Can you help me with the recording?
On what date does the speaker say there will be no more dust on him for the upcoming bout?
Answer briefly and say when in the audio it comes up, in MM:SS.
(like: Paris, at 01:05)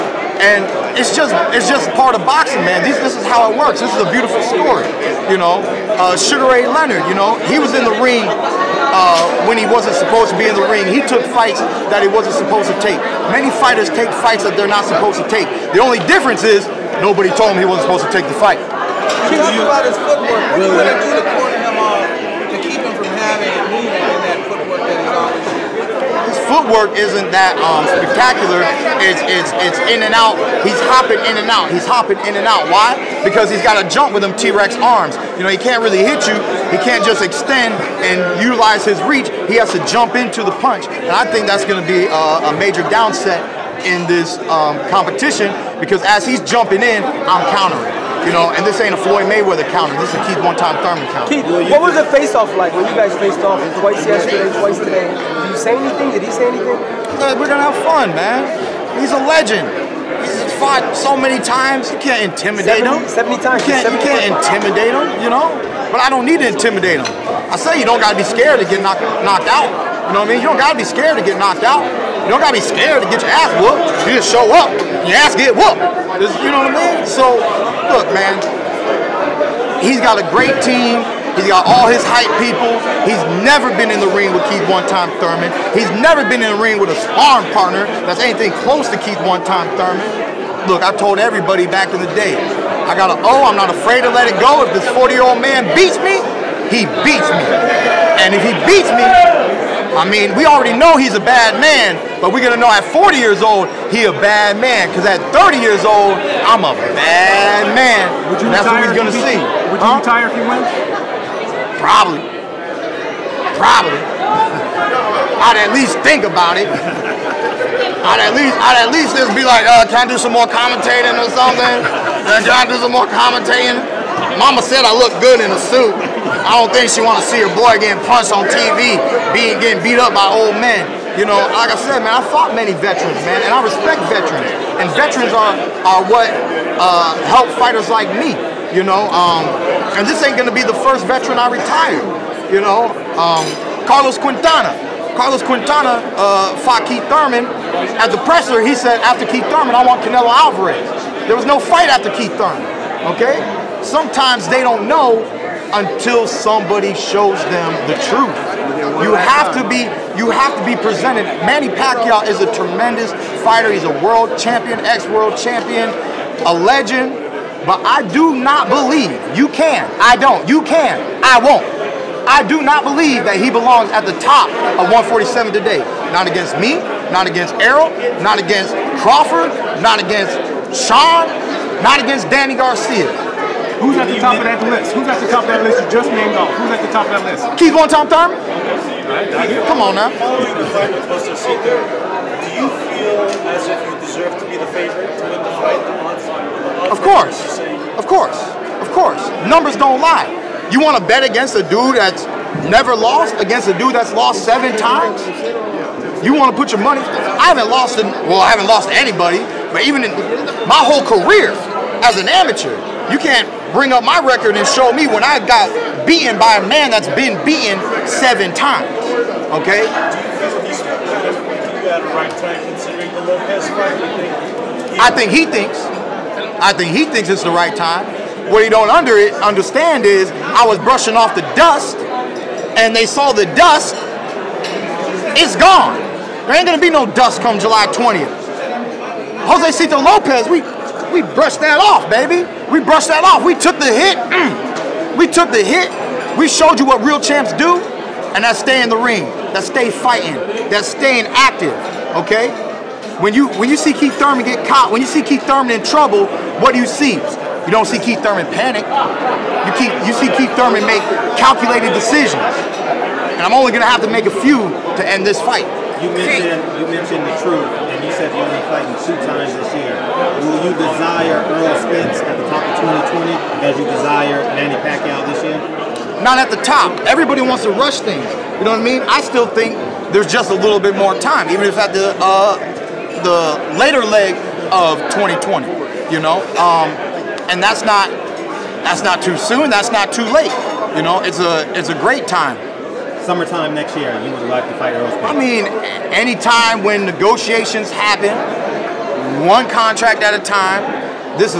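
July 20th, at 03:57.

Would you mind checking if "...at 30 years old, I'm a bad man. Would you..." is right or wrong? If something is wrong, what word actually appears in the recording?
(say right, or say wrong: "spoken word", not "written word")
right.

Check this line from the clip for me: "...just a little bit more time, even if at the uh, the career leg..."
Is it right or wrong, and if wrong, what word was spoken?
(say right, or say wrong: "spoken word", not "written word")
wrong: "later", not "career".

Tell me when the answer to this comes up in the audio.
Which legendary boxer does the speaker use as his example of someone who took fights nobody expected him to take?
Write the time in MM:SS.
00:06.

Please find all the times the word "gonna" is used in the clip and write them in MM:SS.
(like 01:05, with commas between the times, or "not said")
00:57, 01:42, 01:48, 02:20, 03:56, 04:23.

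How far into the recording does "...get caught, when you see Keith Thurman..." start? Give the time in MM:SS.
04:14.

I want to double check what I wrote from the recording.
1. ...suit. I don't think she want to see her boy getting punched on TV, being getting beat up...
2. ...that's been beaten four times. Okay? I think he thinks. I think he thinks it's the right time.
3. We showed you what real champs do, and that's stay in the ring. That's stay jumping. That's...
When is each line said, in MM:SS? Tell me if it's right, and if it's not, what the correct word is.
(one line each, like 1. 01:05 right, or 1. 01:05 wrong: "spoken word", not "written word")
1. 02:05 right
2. 03:36 wrong: "seven", not "four"
3. 04:06 wrong: "fighting", not "jumping".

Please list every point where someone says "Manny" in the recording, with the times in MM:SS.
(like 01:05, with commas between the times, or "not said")
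02:41, 04:34.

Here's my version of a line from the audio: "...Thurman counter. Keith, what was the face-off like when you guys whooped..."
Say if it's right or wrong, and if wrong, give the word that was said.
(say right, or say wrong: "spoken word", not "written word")
wrong: "faced", not "whooped".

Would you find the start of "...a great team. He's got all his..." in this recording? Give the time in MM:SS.
01:20.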